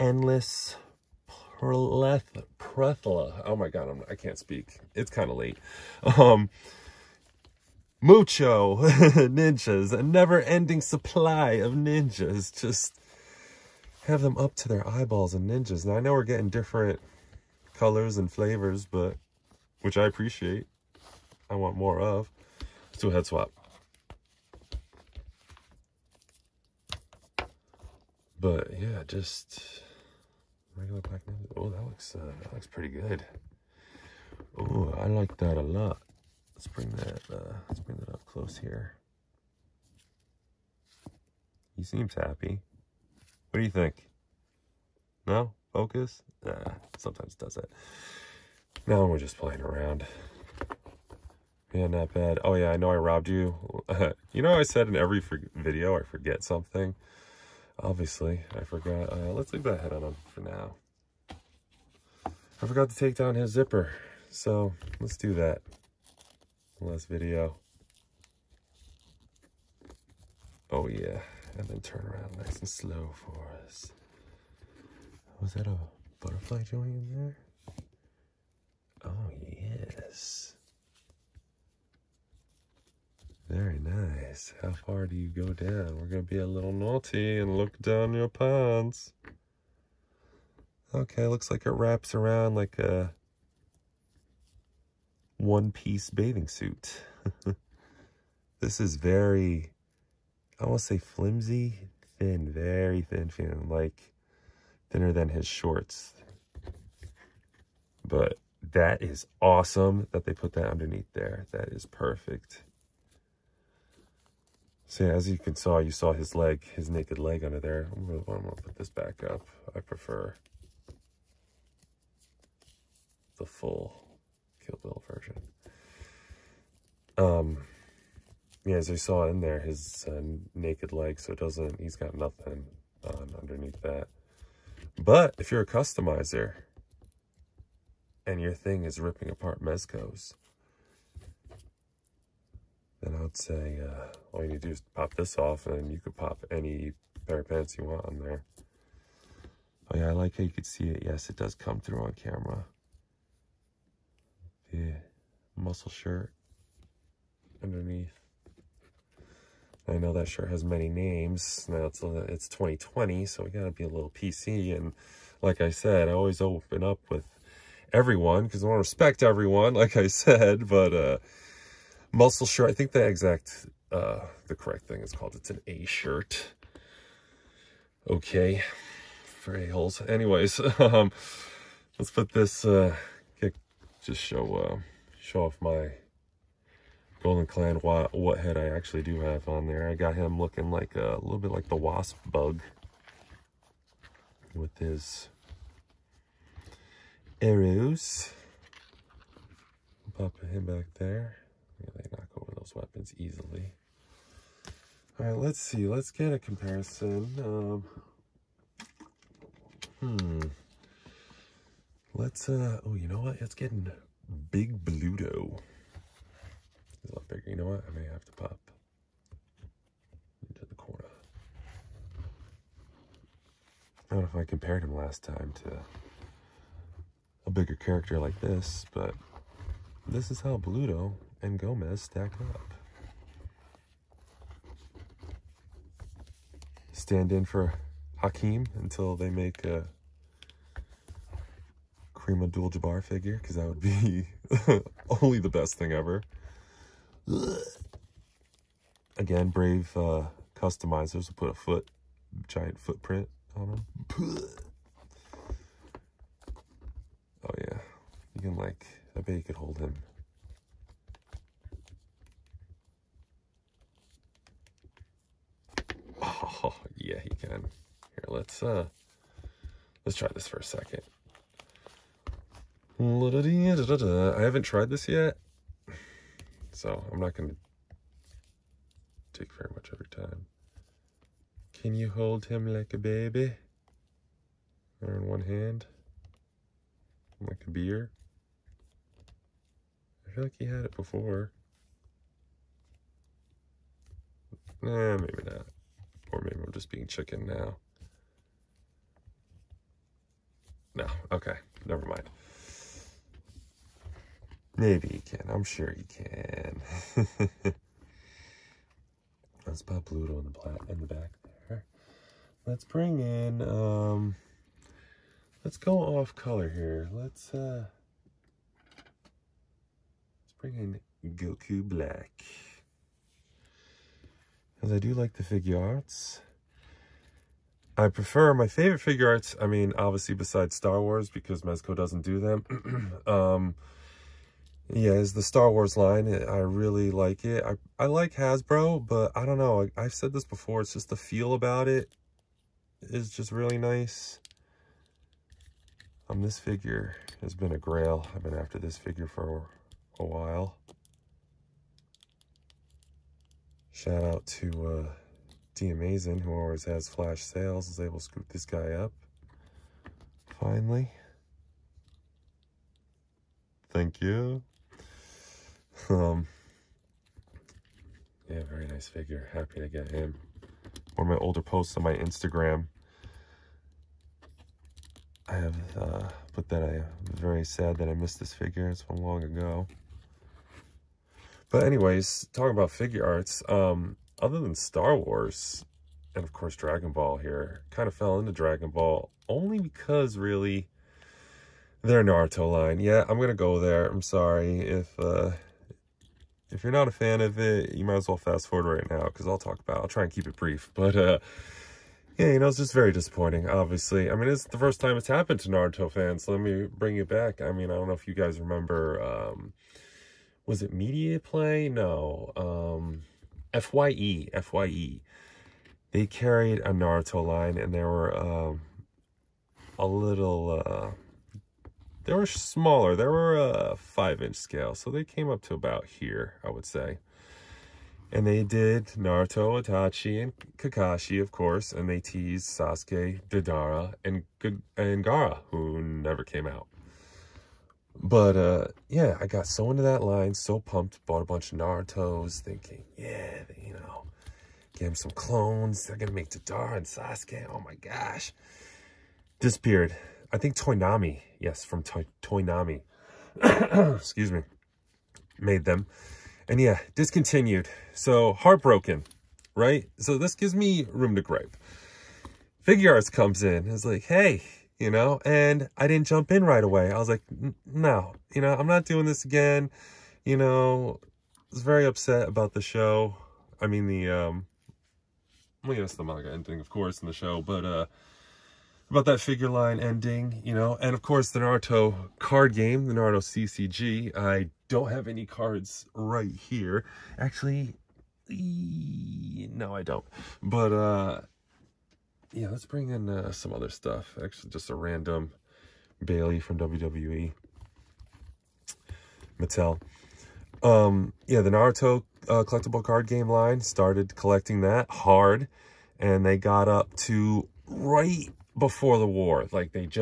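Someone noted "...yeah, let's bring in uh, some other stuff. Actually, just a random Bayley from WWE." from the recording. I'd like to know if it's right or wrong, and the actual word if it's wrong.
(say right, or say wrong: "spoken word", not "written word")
right.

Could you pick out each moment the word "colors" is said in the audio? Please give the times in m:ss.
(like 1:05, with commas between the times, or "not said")
0:17, 5:16.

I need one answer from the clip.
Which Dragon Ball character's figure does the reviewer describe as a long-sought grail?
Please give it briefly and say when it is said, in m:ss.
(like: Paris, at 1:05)
Goku Black, at 5:21.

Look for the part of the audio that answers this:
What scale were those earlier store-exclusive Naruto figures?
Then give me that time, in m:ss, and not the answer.
7:03.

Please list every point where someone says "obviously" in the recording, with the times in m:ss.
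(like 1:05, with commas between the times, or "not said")
0:57, 5:29, 6:43.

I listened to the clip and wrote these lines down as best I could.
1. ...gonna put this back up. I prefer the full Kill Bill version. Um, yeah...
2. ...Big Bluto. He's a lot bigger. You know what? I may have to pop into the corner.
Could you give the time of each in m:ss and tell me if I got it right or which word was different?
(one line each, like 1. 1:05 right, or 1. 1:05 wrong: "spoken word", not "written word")
1. 1:58 right
2. 3:34 right.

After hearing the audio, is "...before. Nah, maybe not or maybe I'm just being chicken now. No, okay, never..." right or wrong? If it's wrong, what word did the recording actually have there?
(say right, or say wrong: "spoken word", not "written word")
right.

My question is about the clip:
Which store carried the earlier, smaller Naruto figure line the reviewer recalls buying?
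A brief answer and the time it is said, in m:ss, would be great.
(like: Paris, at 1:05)
FYE, at 6:53.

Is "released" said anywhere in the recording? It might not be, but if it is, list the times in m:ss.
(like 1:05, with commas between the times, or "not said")
not said.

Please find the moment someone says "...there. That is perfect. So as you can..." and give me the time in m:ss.
1:51.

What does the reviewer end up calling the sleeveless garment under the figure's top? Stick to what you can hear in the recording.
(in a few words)
A shirt.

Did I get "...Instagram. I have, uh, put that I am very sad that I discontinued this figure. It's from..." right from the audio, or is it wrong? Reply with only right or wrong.
wrong.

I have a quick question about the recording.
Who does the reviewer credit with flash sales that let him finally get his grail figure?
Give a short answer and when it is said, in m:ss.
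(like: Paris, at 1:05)
D Amazing, at 5:55.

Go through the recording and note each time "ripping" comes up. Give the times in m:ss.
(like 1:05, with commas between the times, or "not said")
2:18.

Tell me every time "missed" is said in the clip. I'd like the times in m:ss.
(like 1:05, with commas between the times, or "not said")
6:18.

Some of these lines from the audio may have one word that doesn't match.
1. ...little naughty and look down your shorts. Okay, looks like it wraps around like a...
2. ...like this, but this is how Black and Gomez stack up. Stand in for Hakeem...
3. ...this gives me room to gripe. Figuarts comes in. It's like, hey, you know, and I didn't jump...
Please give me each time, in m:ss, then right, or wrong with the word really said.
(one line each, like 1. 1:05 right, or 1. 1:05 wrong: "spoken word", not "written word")
1. 1:26 wrong: "pants", not "shorts"
2. 3:48 wrong: "Bluto", not "Black"
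3. 7:40 right.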